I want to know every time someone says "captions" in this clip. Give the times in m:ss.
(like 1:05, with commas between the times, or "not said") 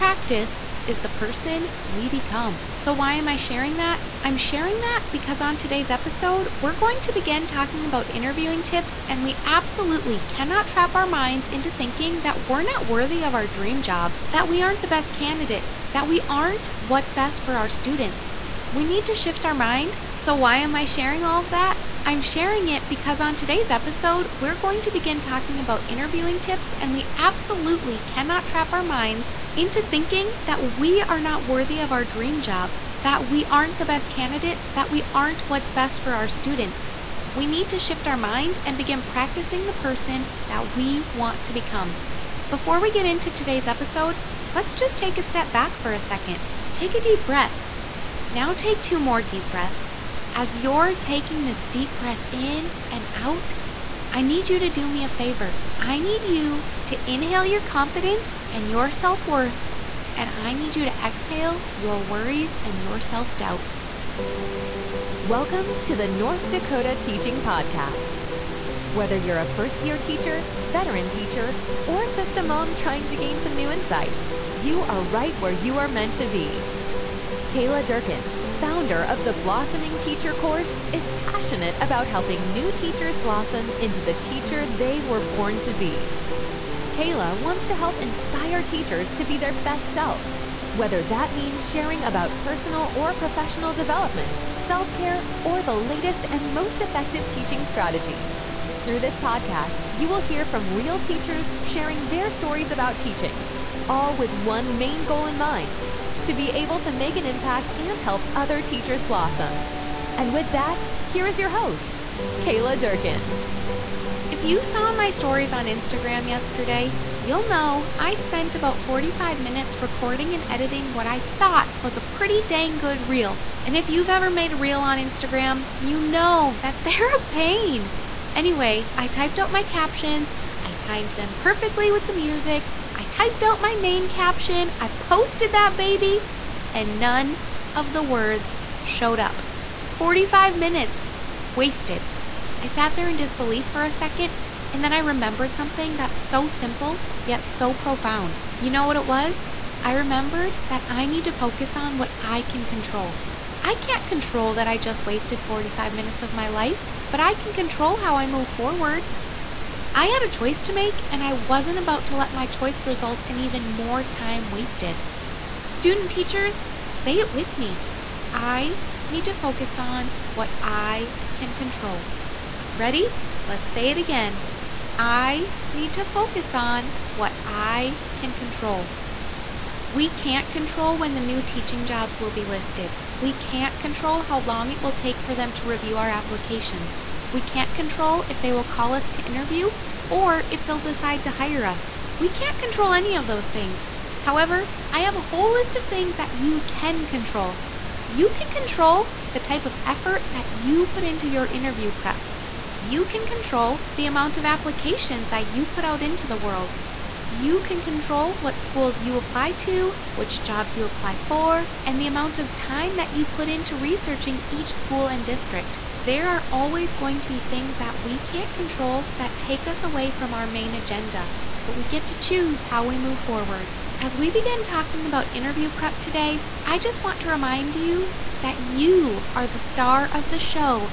2:09, 2:14.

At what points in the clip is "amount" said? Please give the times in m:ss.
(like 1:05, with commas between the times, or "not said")
3:24, 3:32.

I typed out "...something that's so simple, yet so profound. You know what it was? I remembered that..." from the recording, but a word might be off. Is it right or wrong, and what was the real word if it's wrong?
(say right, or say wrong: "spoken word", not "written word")
right.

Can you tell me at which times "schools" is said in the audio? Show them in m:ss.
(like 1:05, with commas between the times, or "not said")
3:28, 3:34.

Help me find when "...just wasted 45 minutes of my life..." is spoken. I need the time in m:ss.
2:34.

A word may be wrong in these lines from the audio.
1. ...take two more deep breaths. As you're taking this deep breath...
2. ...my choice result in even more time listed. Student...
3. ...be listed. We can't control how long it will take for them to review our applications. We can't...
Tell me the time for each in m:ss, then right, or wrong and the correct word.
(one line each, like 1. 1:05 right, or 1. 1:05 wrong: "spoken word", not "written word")
1. 0:48 right
2. 2:42 wrong: "wasted", not "listed"
3. 3:02 right.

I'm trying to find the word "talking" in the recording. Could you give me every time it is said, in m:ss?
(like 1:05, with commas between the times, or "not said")
0:07, 0:25, 3:44.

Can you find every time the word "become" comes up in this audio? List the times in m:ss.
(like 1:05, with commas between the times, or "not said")
0:02, 0:41.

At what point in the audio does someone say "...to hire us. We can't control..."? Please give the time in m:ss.
3:11.